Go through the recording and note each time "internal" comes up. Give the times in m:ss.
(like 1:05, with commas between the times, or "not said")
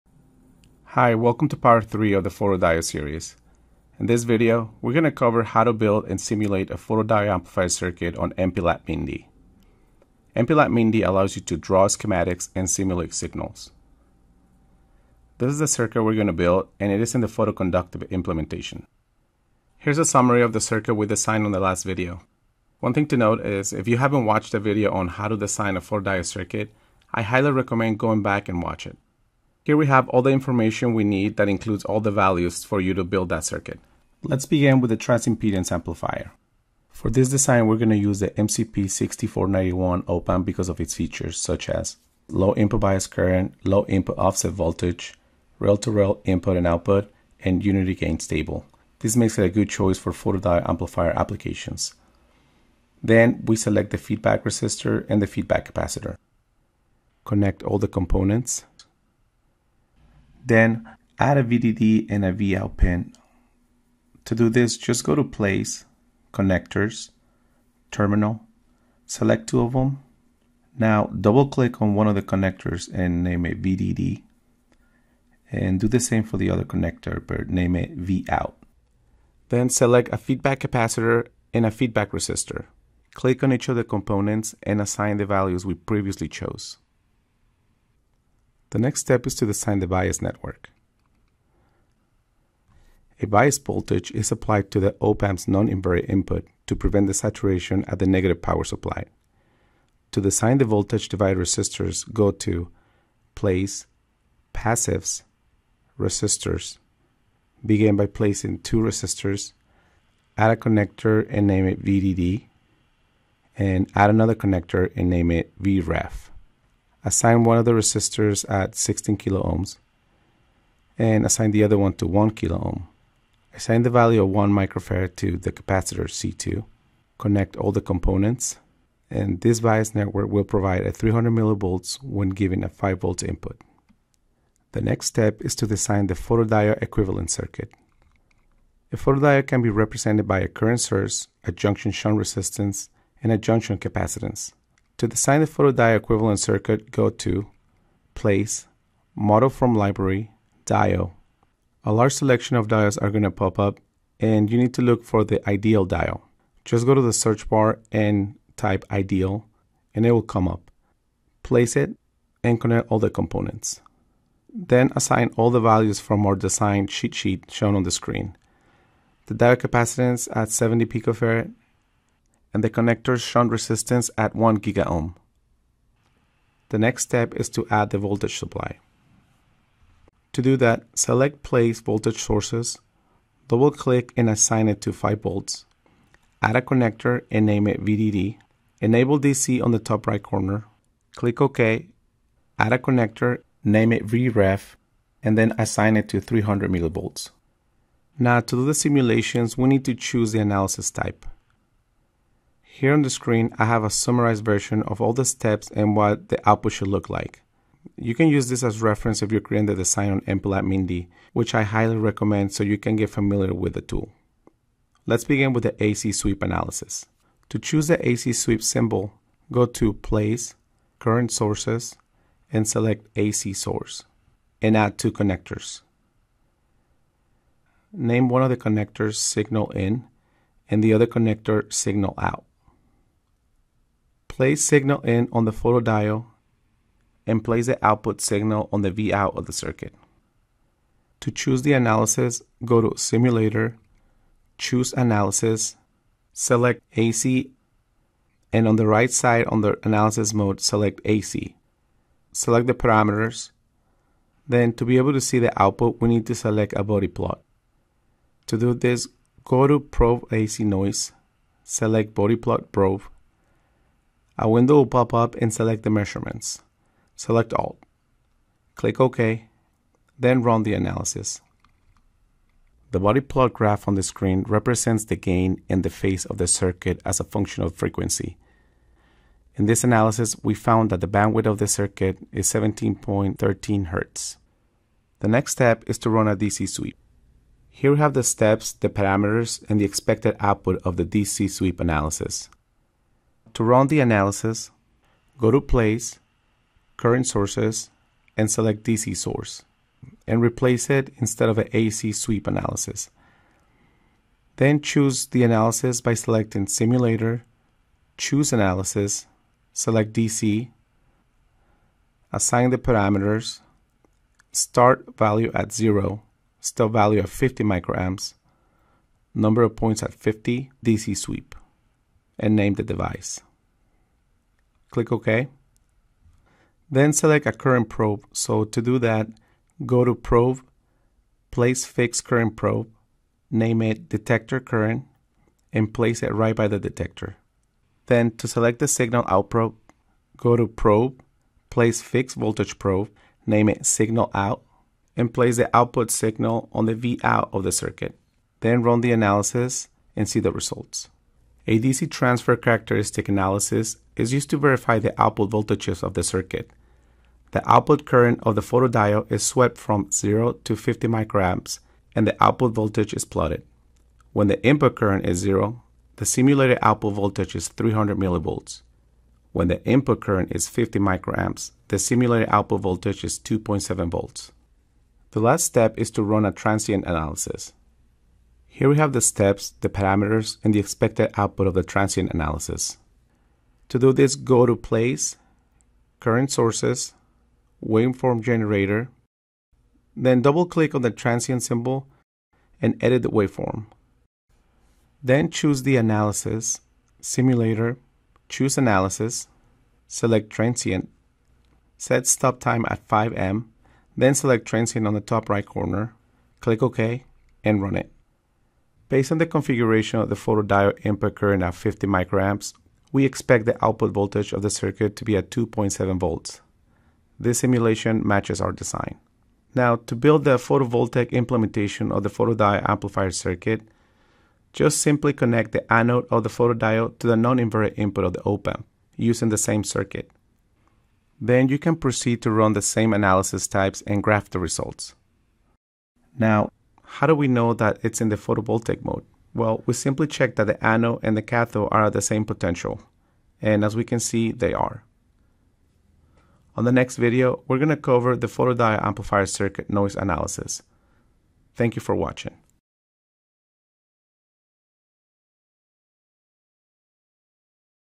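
not said.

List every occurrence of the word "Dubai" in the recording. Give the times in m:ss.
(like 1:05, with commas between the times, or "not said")
not said.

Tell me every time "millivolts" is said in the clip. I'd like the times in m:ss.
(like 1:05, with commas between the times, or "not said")
2:11, 3:16, 6:08.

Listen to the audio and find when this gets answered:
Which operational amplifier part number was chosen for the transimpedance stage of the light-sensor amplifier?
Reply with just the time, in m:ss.
0:38.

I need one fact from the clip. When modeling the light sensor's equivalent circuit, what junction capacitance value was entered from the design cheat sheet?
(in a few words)
70 picofarads.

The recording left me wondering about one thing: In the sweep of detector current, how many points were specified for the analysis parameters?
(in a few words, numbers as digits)
50.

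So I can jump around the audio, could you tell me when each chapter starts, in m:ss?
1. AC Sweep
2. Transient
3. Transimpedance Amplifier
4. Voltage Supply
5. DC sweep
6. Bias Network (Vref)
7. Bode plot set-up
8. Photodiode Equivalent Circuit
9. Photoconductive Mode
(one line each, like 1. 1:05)
1. 3:21
2. 6:15
3. 0:34
4. 2:50
5. 4:47
6. 1:32
7. 4:12
8. 2:17
9. 0:20.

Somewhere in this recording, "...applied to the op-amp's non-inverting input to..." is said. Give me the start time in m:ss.
1:34.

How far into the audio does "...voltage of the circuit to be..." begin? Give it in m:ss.
6:54.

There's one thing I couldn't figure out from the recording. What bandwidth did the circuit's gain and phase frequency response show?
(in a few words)
17.13 Hz.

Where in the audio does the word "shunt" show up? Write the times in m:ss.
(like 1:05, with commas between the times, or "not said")
2:21, 2:53.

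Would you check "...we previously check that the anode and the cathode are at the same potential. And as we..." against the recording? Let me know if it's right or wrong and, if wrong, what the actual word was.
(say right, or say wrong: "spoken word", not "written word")
wrong: "simply", not "previously".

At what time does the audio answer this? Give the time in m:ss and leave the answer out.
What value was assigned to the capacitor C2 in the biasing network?
2:04.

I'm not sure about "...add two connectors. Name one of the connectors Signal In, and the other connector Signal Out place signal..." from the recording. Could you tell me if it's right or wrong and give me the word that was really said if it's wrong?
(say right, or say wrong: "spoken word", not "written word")
right.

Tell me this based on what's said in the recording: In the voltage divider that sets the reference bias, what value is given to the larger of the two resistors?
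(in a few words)
16 kilo ohms.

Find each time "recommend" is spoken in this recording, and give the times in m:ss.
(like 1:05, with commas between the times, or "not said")
0:27, 3:31.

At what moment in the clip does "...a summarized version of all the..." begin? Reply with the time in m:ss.
3:23.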